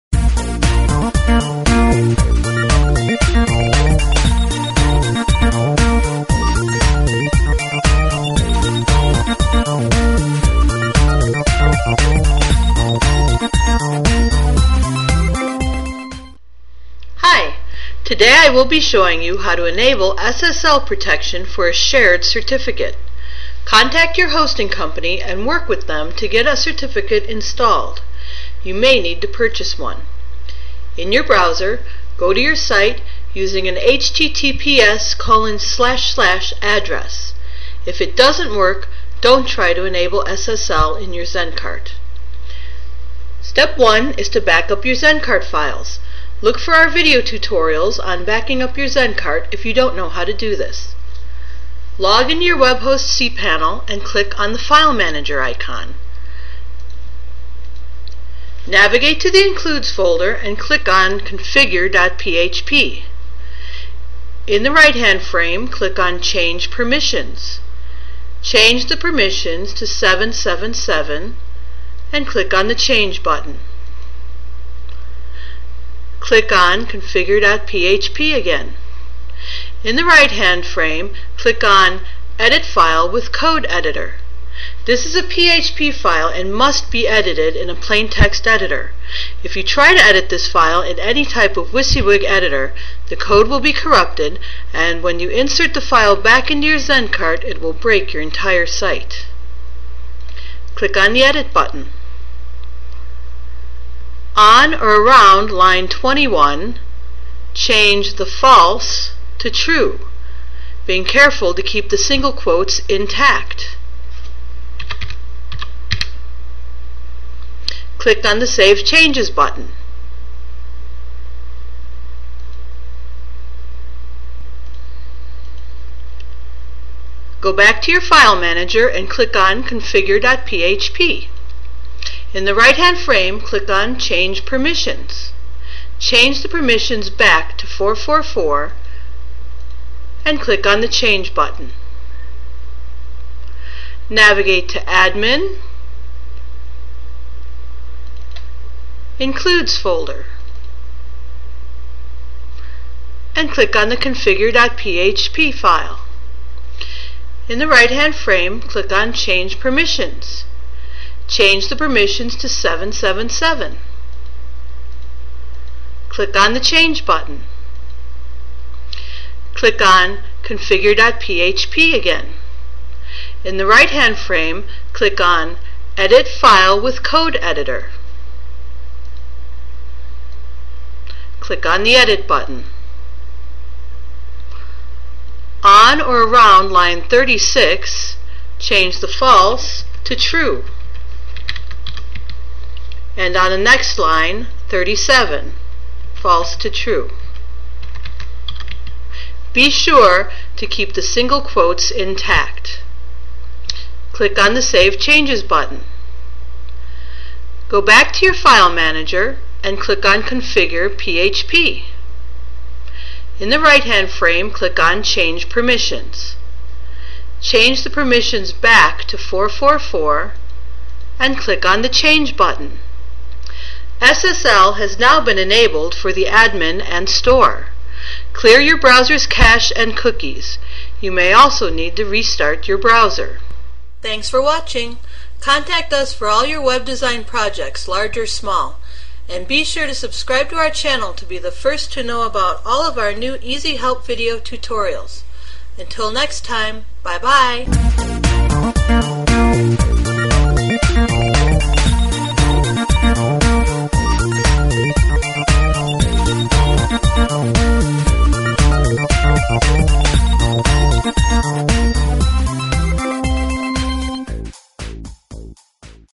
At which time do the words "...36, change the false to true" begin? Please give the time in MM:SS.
03:07.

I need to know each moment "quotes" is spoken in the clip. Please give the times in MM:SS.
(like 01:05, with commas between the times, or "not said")
01:52, 03:21.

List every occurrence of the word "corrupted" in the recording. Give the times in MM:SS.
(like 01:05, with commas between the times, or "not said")
01:33.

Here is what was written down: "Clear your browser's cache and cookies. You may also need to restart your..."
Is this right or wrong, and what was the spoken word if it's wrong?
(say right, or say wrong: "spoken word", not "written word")
right.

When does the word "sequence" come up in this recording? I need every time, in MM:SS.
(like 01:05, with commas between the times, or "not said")
not said.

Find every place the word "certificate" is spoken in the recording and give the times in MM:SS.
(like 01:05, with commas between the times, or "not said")
00:22, 00:26.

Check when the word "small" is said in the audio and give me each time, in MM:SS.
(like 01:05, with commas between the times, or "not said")
03:58.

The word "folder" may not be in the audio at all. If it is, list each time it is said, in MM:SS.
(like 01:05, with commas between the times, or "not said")
00:59, 02:29.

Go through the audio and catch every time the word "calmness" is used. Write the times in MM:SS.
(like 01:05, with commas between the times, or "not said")
not said.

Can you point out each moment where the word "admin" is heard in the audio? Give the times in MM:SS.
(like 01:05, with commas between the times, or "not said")
02:24, 03:46.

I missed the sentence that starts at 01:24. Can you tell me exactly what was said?
This is a PHP file and must be edited in a plain text editor.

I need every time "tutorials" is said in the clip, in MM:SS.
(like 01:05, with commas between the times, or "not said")
00:47, 04:04.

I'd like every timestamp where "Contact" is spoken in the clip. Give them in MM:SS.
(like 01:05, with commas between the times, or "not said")
00:23, 03:55.